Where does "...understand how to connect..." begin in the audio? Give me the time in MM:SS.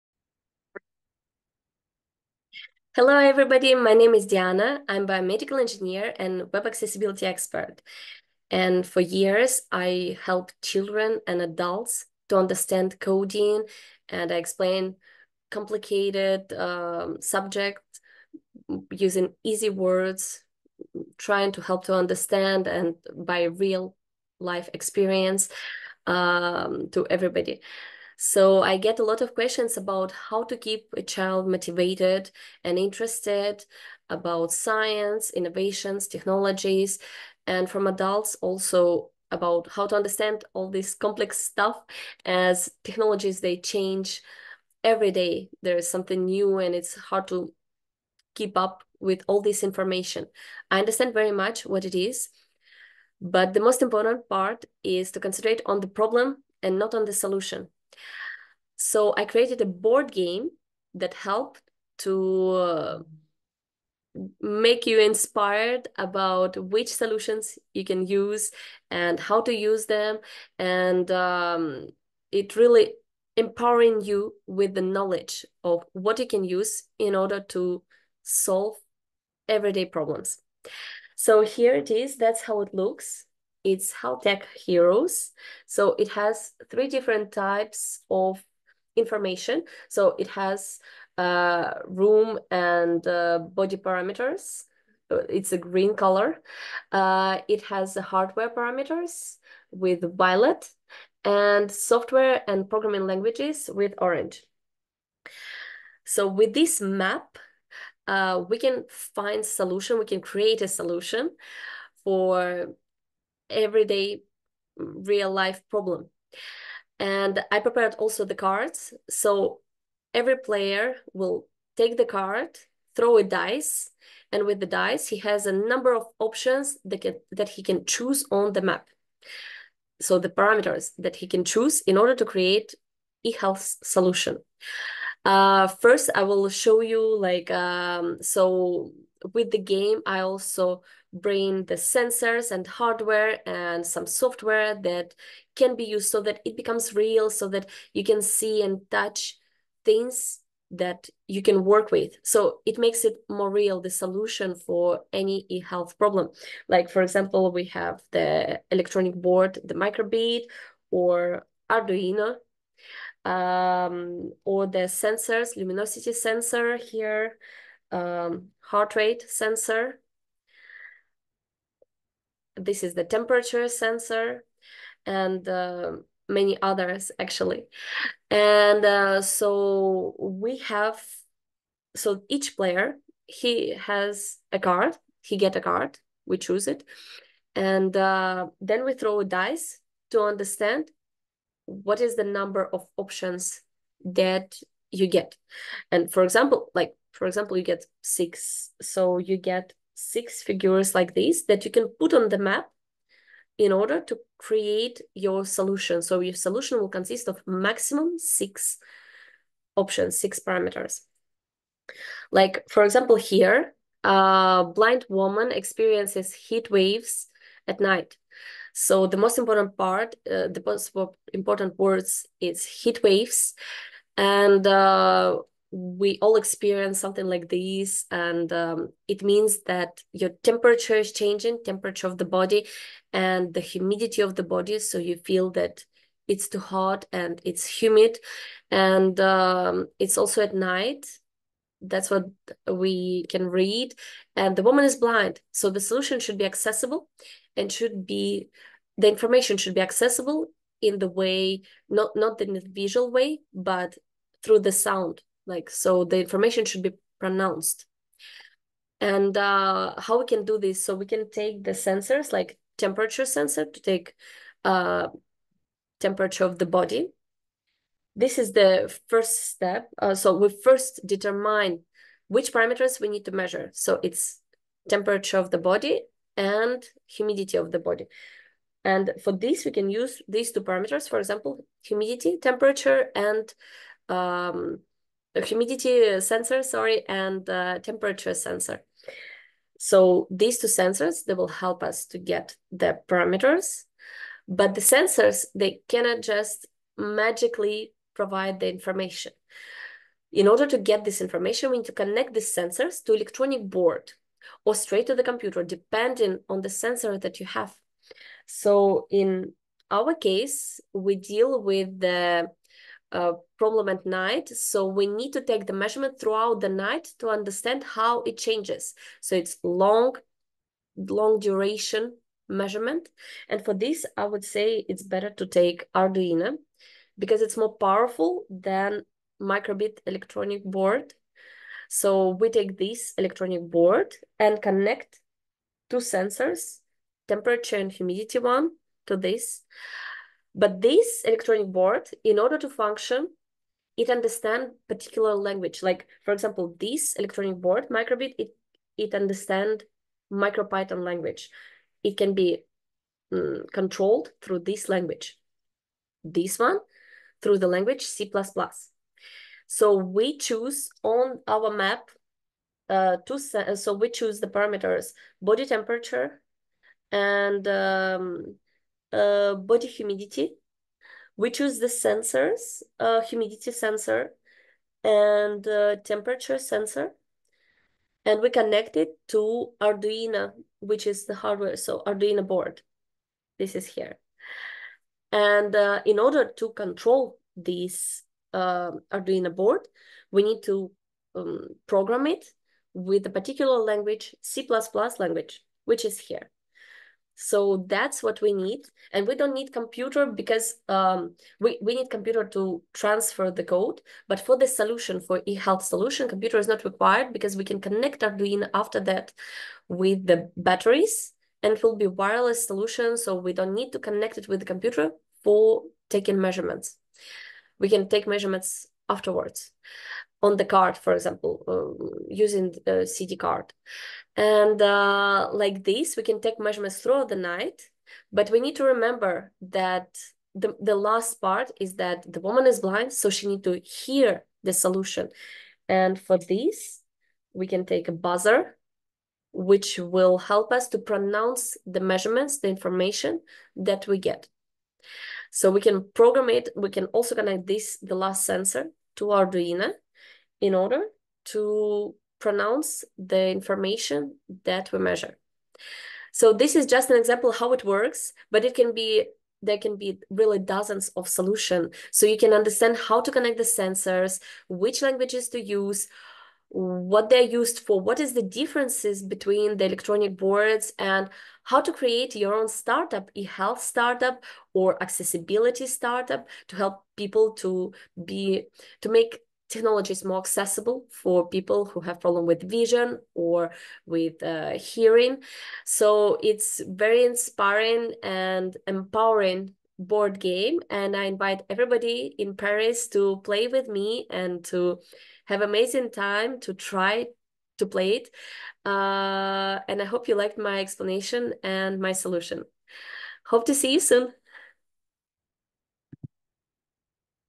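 07:42.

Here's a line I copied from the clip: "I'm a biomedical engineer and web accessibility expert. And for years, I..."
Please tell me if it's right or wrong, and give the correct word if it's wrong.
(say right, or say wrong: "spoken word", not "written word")
right.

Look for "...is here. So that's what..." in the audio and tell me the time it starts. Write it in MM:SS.
06:36.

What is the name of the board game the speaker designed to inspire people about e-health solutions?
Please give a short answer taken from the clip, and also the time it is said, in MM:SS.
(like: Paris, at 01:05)
Health Tech Heroes, at 01:23.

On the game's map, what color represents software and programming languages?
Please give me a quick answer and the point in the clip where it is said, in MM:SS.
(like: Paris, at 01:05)
Orange, at 01:43.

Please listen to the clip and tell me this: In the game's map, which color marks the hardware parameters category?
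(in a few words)
Violet.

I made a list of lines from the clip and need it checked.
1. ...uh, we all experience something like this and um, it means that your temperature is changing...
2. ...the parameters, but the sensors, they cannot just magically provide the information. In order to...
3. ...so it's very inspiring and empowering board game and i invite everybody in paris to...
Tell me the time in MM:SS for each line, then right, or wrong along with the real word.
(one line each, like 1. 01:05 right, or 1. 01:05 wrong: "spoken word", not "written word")
1. 03:44 right
2. 04:52 right
3. 08:05 right.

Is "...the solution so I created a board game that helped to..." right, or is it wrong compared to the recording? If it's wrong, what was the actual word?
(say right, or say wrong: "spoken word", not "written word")
right.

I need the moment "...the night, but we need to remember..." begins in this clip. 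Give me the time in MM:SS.
07:07.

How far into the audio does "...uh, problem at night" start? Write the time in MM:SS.
05:13.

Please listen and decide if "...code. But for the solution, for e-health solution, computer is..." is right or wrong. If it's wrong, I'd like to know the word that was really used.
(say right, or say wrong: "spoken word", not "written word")
right.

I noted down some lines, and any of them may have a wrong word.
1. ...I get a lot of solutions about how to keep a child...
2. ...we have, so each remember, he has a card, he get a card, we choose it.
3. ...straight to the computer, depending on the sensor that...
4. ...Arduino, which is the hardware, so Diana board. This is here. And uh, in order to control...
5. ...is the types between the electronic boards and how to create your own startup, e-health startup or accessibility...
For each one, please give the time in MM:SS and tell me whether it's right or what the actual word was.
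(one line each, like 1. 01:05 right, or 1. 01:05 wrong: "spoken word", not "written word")
1. 00:28 wrong: "questions", not "solutions"
2. 03:00 wrong: "player", not "remember"
3. 05:04 right
4. 06:19 wrong: "Arduino", not "Diana"
5. 07:48 wrong: "differences", not "types".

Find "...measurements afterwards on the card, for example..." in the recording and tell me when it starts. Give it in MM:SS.
06:58.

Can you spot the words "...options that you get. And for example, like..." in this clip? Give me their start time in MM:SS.
03:12.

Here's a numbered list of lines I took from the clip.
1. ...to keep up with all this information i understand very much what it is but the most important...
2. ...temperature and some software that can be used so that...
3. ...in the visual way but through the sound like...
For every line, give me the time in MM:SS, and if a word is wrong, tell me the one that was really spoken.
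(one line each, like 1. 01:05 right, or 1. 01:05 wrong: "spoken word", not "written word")
1. 00:47 right
2. 02:22 wrong: "hardware", not "temperature"
3. 04:12 right.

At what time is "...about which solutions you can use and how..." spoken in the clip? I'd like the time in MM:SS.
01:05.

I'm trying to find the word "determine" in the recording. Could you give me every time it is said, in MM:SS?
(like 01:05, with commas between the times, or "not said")
04:31.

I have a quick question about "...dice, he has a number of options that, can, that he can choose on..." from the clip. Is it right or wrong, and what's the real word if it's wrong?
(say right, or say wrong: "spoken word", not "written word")
right.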